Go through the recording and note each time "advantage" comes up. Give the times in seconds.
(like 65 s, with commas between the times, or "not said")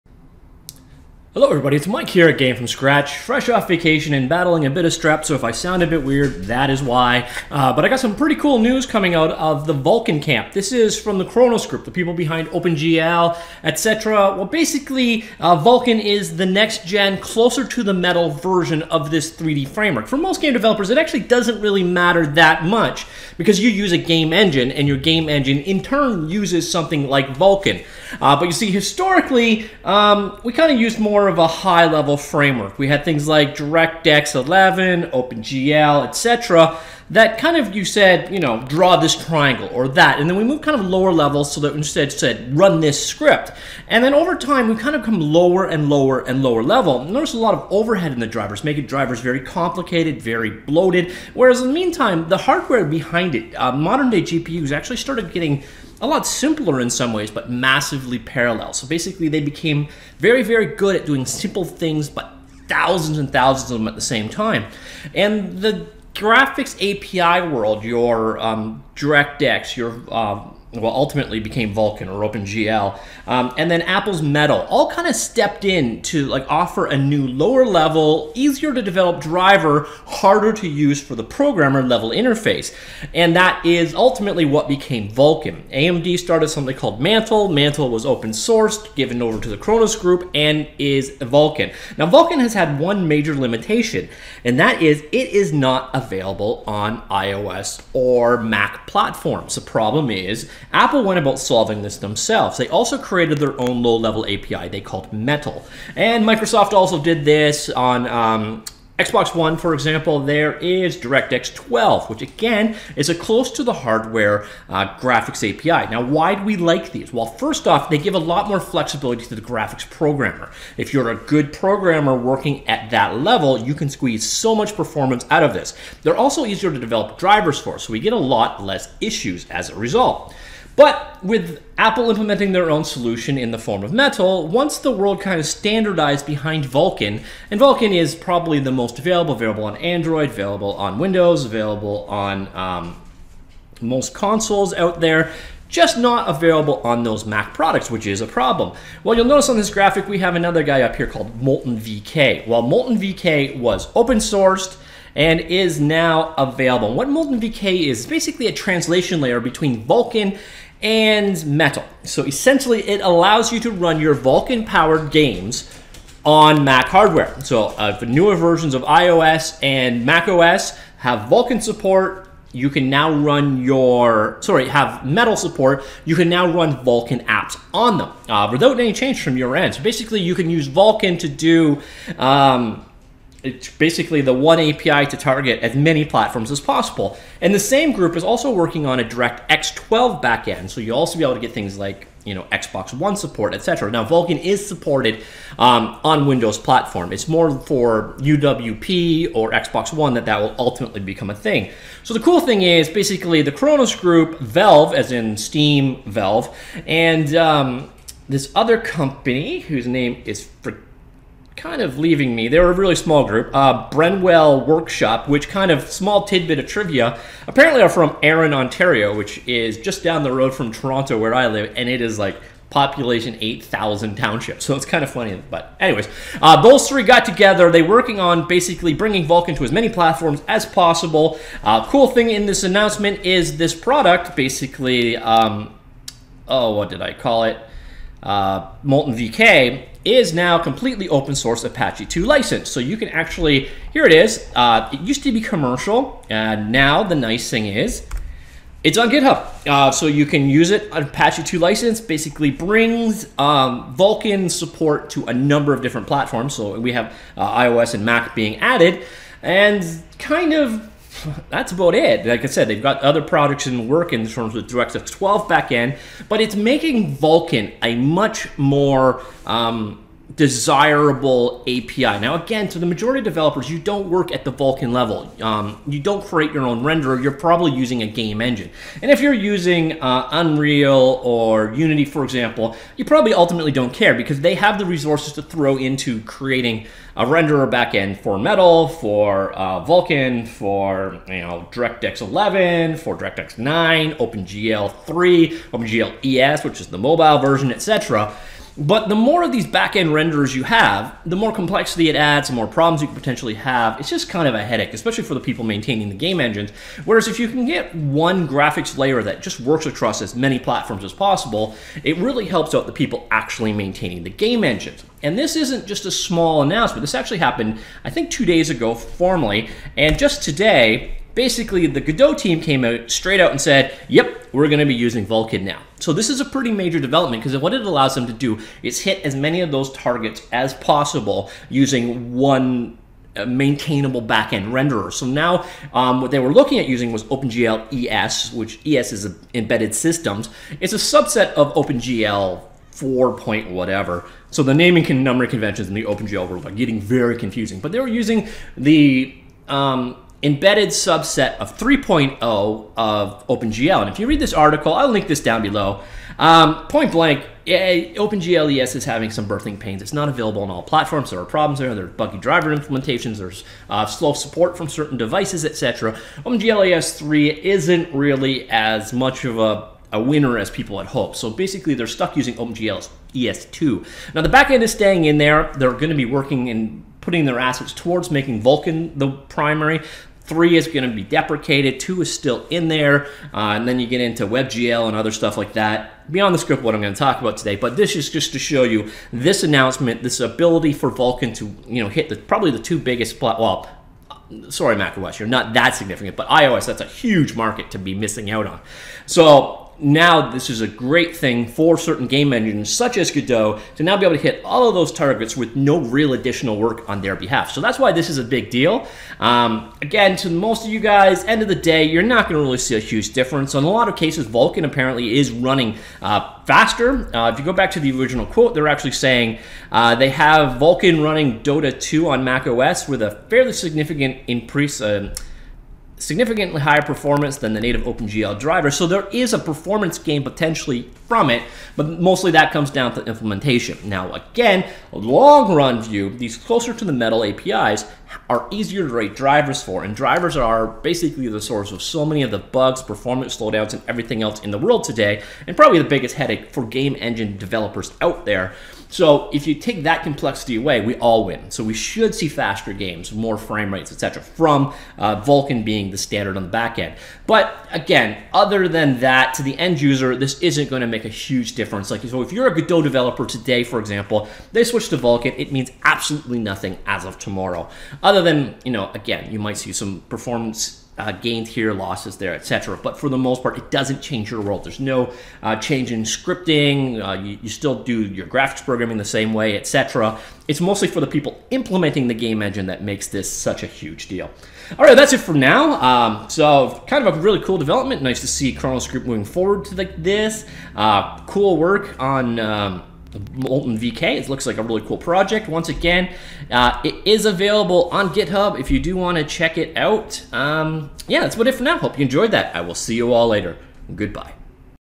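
not said.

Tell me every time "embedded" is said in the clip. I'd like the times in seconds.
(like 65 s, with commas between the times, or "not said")
339 s, 350 s.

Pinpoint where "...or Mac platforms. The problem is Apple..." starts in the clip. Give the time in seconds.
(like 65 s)
97 s.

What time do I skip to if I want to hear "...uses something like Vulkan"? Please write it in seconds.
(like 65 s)
26 s.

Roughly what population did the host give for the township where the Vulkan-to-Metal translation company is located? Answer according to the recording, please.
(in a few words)
8,000.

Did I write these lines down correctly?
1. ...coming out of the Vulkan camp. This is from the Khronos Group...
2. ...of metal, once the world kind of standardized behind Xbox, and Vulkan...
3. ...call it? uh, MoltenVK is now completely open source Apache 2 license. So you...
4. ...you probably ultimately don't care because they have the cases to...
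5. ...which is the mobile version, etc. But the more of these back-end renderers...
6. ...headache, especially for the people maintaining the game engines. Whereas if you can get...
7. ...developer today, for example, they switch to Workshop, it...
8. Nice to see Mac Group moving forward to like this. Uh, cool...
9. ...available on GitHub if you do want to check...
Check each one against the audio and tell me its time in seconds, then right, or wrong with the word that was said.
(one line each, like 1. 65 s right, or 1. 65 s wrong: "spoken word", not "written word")
1. 8 s right
2. 133 s wrong: "Vulkan", not "Xbox"
3. 237 s right
4. 282 s wrong: "resources", not "cases"
5. 296 s right
6. 304 s right
7. 463 s wrong: "Vulkan", not "Workshop"
8. 488 s wrong: "Khronos", not "Mac"
9. 497 s right.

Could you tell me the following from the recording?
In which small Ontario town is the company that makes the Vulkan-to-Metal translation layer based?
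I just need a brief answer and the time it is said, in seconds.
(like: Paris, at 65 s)
Erin, Ontario, at 218 s.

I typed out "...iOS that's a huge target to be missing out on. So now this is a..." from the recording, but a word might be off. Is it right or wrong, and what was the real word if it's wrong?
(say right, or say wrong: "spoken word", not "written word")
wrong: "market", not "target".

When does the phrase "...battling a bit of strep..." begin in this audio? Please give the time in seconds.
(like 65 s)
4 s.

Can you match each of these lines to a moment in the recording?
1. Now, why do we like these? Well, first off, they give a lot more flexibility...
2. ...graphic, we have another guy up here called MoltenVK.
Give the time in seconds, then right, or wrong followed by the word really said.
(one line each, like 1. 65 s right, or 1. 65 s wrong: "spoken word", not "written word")
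1. 115 s right
2. 149 s right.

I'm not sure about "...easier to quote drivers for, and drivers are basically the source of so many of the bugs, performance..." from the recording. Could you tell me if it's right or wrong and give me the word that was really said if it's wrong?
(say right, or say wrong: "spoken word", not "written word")
wrong: "write", not "quote".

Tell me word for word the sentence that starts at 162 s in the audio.
So essentially, it allows you to run your Vulkan powered games on Mac hardware.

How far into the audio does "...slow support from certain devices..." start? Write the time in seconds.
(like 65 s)
364 s.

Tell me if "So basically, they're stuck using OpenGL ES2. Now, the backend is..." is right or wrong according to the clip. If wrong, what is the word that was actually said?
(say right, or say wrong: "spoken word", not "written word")
right.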